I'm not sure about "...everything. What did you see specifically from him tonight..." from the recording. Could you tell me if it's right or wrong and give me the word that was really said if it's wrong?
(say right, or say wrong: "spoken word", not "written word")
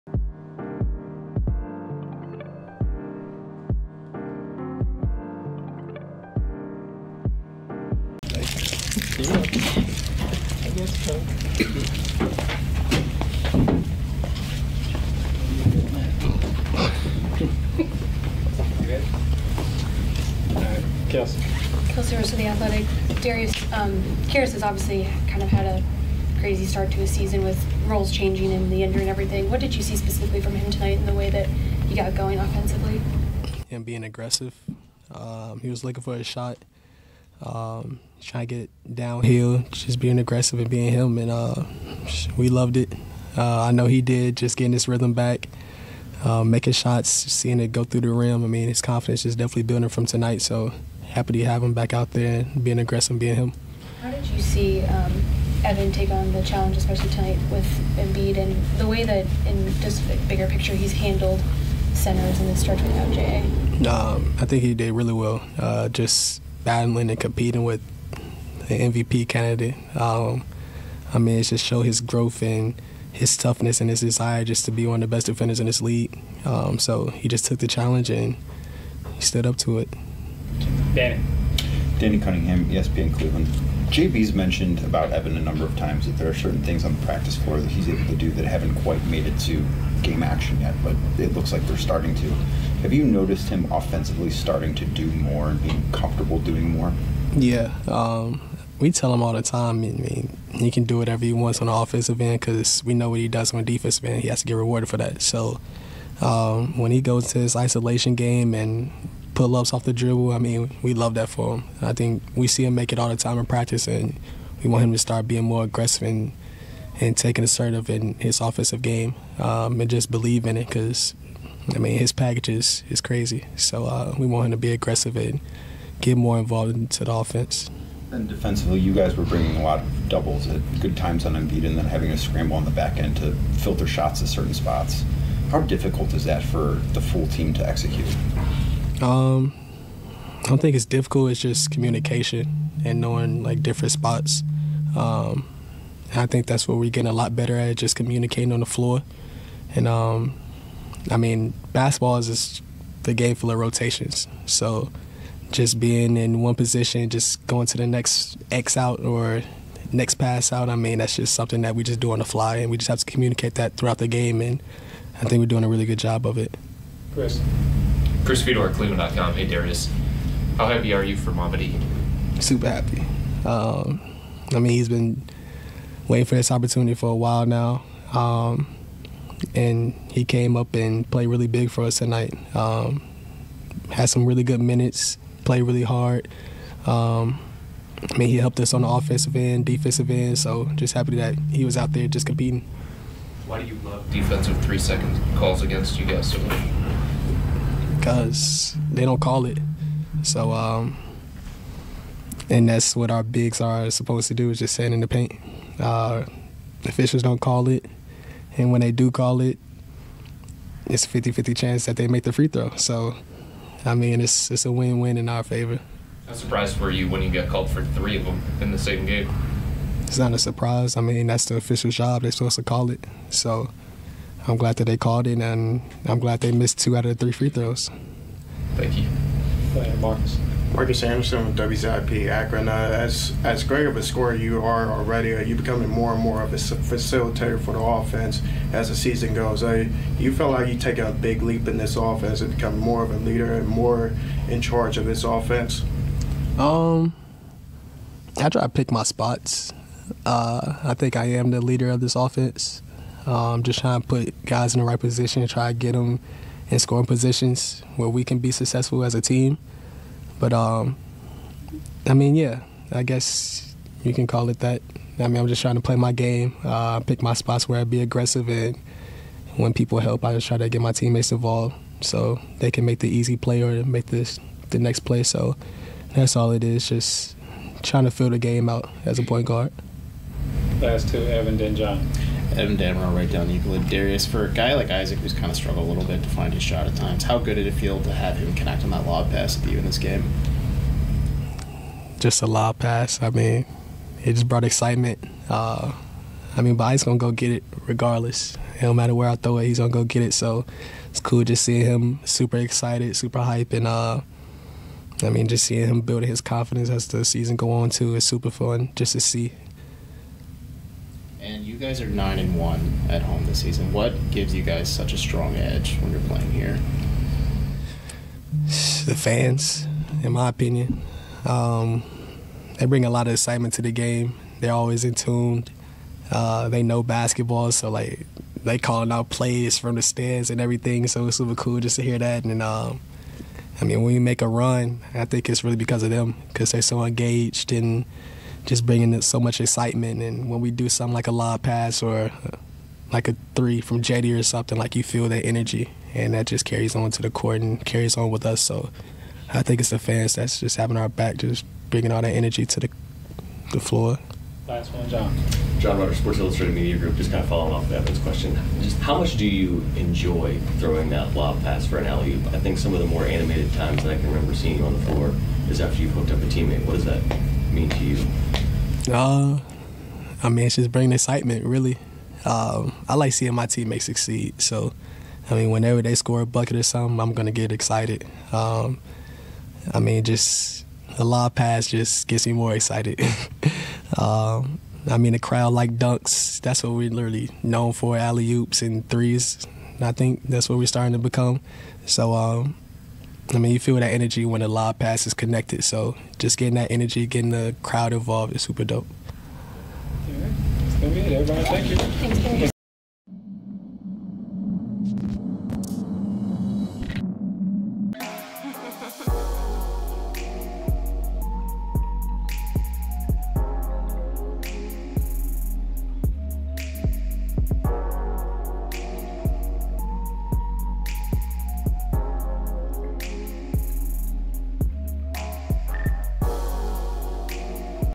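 right.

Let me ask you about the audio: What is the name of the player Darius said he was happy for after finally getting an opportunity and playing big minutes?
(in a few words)
Mamadi.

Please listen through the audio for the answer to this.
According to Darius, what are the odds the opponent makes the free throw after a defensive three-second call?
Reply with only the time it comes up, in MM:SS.
03:31.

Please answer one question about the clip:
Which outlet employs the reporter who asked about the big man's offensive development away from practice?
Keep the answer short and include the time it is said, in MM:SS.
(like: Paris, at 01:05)
ESPN Cleveland, at 01:22.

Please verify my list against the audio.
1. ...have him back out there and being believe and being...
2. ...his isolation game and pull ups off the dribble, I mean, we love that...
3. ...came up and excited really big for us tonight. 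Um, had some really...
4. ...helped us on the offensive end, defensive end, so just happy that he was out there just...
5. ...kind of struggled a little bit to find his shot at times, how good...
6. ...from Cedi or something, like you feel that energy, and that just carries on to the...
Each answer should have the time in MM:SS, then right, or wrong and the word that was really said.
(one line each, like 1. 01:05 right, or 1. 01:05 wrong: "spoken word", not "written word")
1. 00:51 wrong: "aggressive", not "believe"
2. 01:47 right
3. 03:00 wrong: "played", not "excited"
4. 03:08 right
5. 04:45 right
6. 05:43 right.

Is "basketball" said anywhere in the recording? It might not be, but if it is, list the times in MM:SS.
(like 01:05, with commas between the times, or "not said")
02:31, 05:27.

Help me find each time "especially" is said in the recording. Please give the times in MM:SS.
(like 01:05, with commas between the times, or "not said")
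00:56.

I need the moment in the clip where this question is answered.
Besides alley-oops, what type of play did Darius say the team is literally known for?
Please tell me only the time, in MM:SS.
06:29.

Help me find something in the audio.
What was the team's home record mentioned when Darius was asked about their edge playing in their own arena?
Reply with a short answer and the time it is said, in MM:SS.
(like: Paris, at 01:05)
9 and 1, at 05:12.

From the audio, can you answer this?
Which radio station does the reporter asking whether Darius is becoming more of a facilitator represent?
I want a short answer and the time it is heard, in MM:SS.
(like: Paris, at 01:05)
WZIP Akron, at 03:51.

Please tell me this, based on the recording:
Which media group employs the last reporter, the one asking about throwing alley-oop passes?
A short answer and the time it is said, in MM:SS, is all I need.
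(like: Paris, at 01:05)
Sports Illustrated Media Group, at 05:56.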